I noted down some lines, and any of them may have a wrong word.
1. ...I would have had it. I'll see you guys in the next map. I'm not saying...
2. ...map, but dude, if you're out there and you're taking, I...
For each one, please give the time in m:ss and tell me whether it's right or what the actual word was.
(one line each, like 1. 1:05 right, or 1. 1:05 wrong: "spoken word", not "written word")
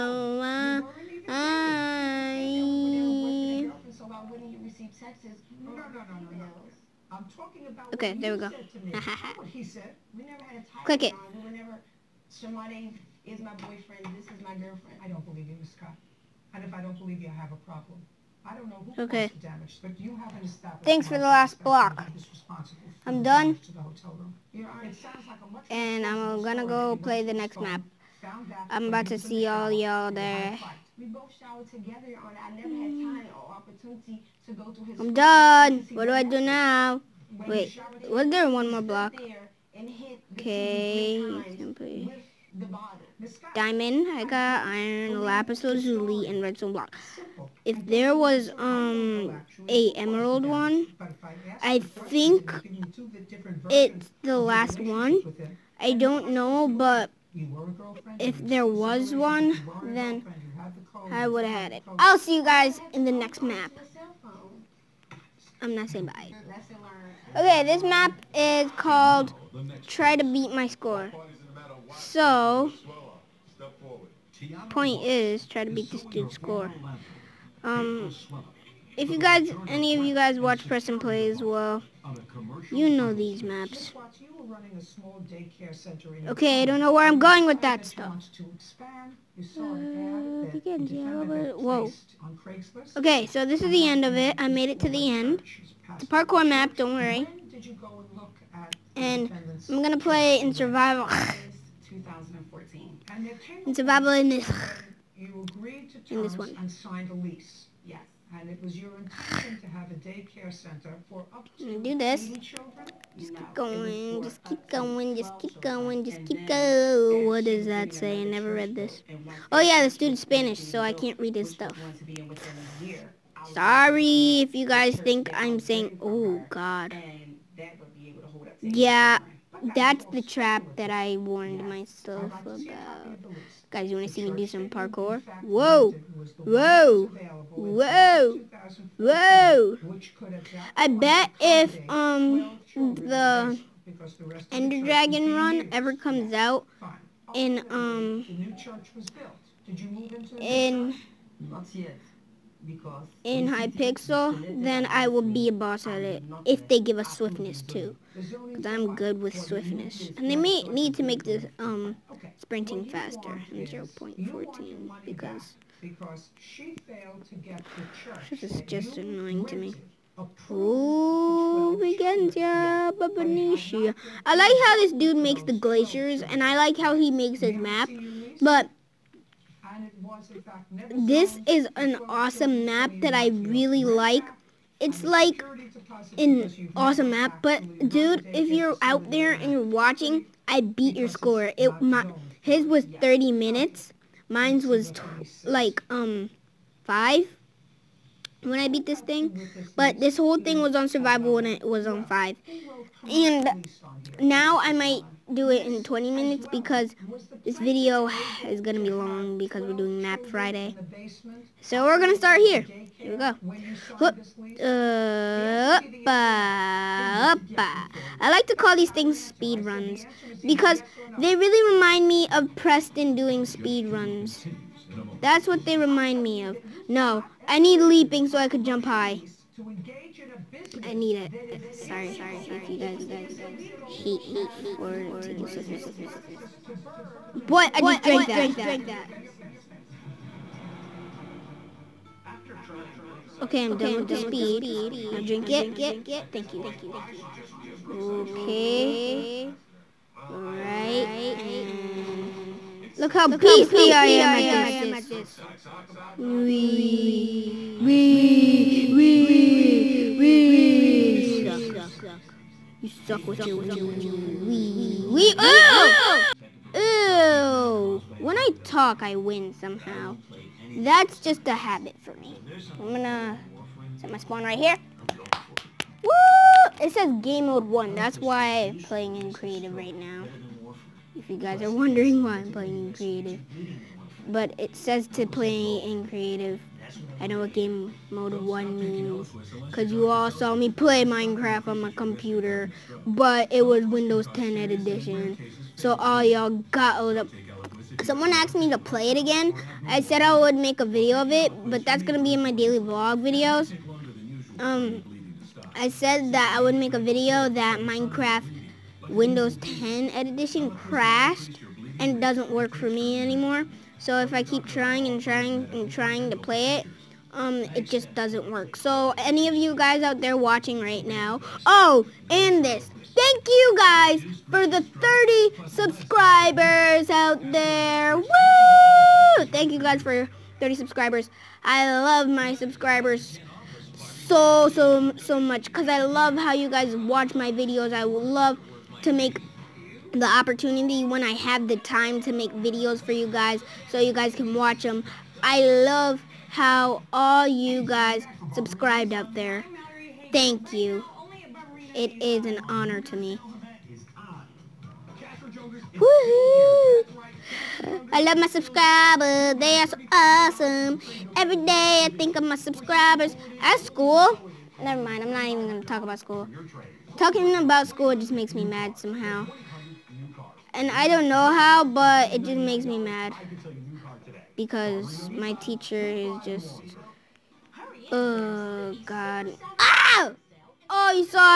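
1. 1:01 right
2. 3:07 wrong: "watching", not "taking".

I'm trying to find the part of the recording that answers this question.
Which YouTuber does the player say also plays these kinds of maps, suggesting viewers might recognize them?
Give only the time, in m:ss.
1:20.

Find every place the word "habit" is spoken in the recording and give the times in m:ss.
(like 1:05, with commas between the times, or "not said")
4:31.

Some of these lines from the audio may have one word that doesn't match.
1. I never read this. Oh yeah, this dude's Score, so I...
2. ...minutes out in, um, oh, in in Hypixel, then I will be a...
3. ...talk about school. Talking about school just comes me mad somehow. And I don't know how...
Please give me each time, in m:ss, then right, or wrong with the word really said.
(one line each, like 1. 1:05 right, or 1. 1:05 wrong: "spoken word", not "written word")
1. 1:58 wrong: "Spanish", not "Score"
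2. 2:25 wrong: "comes", not "minutes"
3. 6:05 wrong: "makes", not "comes".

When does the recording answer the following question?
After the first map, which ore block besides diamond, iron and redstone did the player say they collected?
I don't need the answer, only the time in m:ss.
0:45.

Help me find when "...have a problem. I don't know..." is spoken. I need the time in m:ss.
0:17.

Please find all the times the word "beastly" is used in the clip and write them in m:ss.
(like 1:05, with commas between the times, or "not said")
4:13.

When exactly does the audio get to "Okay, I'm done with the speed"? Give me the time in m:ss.
4:03.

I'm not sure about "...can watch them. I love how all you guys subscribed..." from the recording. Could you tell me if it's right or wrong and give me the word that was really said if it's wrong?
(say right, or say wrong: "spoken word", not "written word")
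right.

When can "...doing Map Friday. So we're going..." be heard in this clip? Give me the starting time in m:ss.
3:29.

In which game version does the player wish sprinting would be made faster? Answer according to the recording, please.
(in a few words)
0.14.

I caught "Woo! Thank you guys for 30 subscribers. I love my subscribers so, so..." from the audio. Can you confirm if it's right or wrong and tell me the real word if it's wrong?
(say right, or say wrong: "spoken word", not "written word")
right.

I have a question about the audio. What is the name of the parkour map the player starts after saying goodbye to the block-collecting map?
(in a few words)
Try to Beat My Score.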